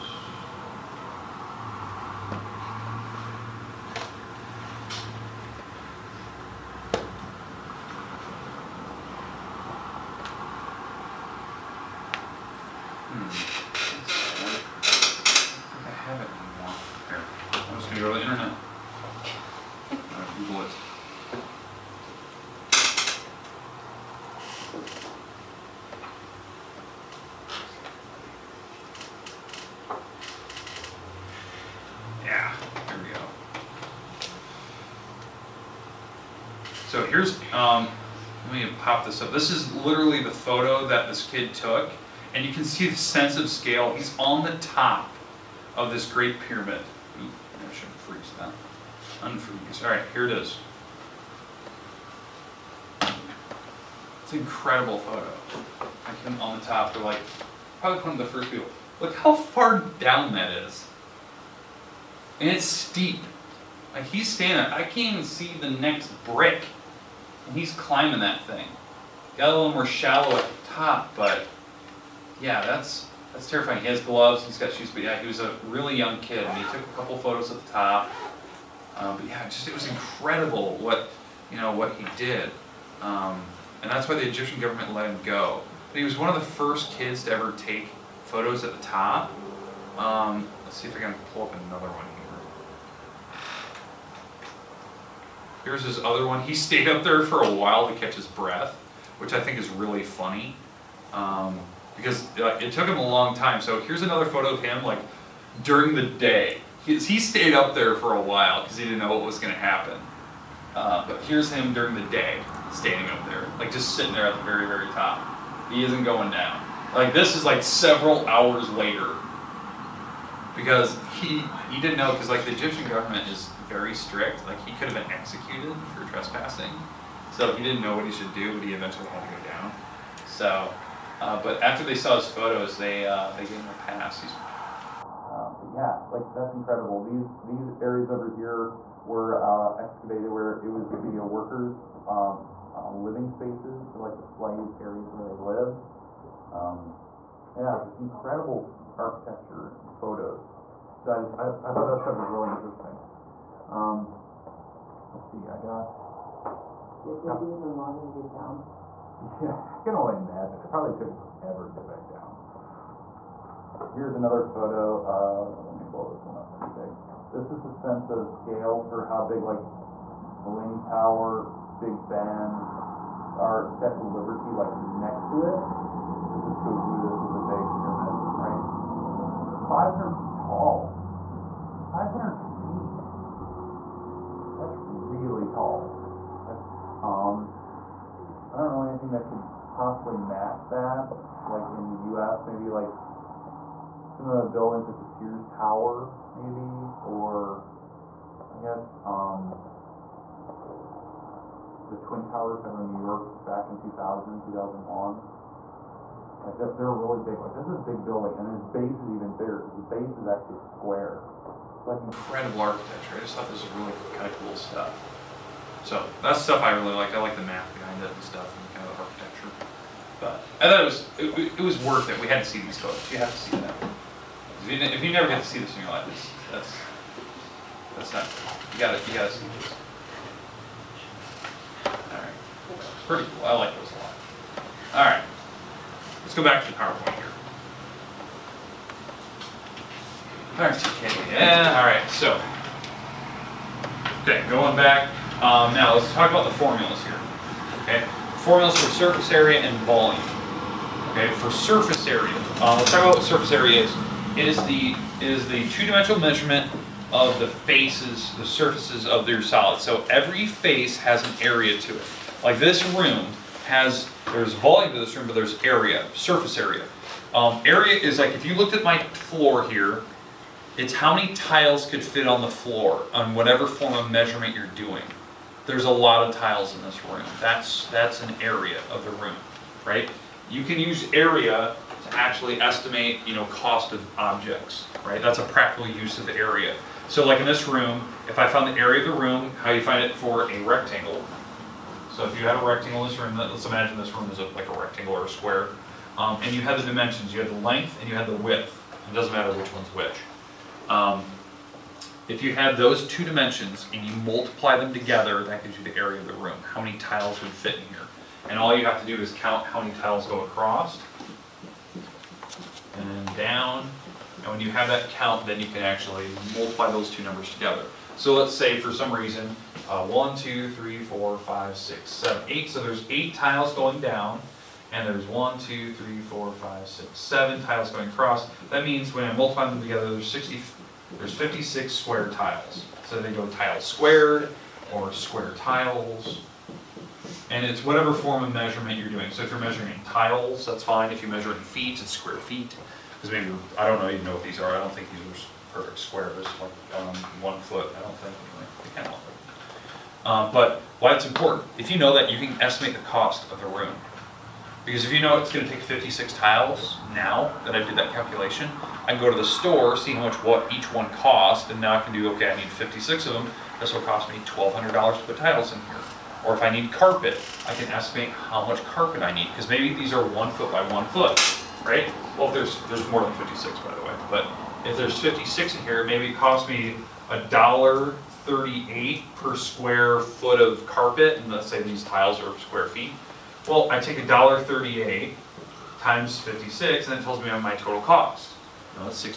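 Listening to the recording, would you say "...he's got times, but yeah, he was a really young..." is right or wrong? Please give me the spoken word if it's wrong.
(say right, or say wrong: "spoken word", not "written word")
wrong: "shoes", not "times".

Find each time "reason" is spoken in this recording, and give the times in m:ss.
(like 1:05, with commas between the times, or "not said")
5:19.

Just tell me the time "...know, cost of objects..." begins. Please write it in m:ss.
4:43.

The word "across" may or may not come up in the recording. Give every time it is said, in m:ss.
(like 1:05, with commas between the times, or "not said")
5:10, 5:28.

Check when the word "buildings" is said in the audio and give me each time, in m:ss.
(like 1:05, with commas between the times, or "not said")
3:14, 3:28.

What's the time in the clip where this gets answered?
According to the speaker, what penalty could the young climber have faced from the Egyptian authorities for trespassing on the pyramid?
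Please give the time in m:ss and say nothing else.
2:05.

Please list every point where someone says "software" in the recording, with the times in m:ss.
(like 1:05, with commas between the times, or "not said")
not said.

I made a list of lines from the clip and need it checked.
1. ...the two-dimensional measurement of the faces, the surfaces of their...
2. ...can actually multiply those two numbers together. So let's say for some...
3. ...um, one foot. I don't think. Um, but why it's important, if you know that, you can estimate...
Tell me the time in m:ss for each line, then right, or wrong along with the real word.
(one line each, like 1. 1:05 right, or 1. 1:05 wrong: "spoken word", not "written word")
1. 4:15 right
2. 5:15 right
3. 5:47 right.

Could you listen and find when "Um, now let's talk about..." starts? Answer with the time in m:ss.
4:05.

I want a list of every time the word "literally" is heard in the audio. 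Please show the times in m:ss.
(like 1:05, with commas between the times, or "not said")
0:39.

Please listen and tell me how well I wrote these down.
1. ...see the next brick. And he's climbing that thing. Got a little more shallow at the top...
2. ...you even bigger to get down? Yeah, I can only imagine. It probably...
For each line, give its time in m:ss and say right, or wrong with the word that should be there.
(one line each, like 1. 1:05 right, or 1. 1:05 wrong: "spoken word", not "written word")
1. 1:05 right
2. 2:37 wrong: "longer", not "bigger".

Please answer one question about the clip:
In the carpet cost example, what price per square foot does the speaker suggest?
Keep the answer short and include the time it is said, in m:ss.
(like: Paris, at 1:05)
$1.38, at 6:17.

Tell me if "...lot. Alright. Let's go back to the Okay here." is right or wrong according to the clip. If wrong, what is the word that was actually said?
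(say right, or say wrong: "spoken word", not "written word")
wrong: "PowerPoint", not "Okay".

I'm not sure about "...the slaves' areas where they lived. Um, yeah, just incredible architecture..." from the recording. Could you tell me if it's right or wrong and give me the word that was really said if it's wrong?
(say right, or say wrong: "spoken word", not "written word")
right.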